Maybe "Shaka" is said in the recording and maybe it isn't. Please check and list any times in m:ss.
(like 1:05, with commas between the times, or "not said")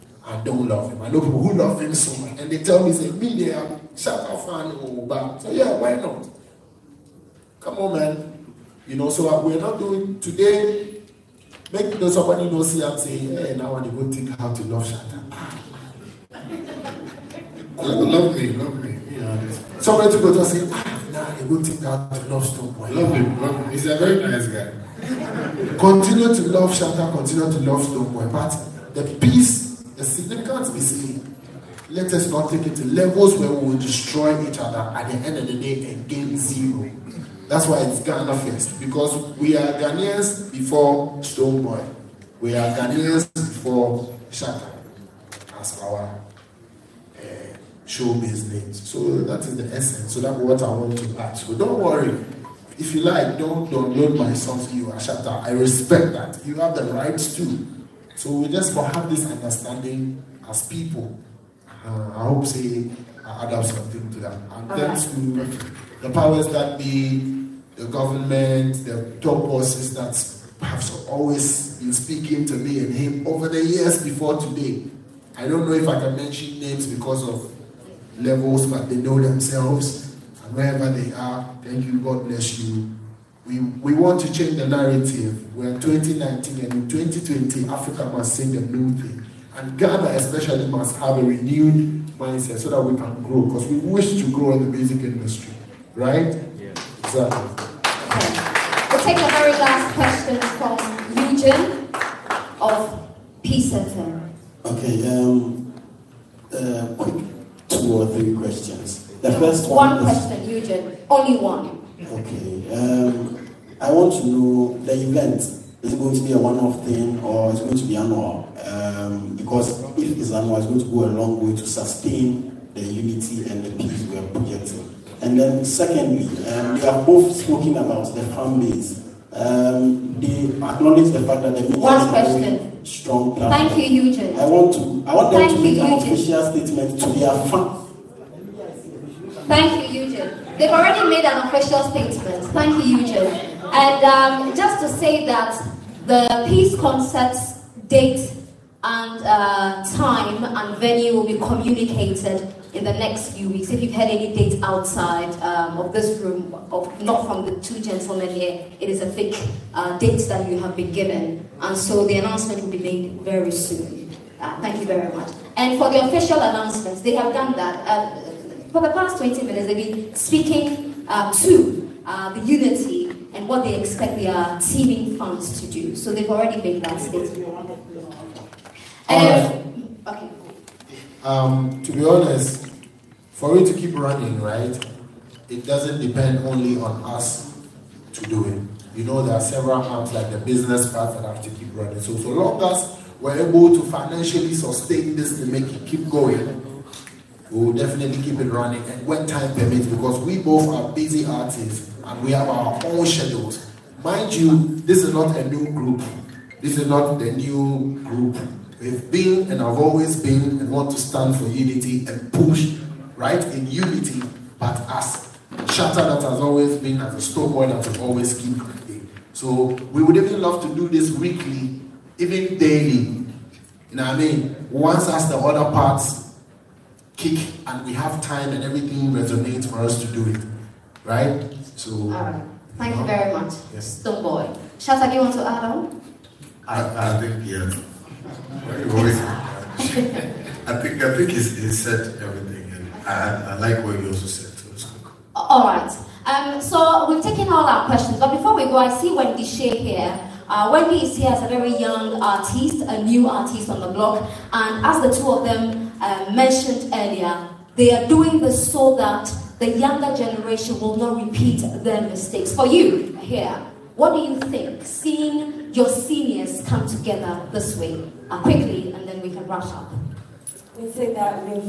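0:03, 0:14, 0:44.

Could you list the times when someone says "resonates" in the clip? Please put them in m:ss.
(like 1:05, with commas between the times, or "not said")
3:49.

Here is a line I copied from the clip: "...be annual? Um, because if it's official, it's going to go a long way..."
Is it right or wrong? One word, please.
wrong.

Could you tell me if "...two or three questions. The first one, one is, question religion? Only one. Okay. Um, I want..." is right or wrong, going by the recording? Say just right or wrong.
right.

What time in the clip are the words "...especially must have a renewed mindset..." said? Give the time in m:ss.
1:30.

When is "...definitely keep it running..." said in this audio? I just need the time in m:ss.
3:17.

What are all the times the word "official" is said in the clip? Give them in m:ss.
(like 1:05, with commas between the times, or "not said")
2:16, 2:21, 2:46.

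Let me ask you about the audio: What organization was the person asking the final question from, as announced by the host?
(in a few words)
Legion of Peace Center.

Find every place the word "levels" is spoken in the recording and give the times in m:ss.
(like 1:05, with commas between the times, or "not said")
0:32, 1:18.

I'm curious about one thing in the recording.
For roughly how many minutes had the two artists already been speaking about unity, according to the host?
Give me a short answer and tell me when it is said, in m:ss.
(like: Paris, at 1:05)
20, at 2:49.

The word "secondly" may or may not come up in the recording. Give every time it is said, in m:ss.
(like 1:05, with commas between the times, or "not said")
2:05.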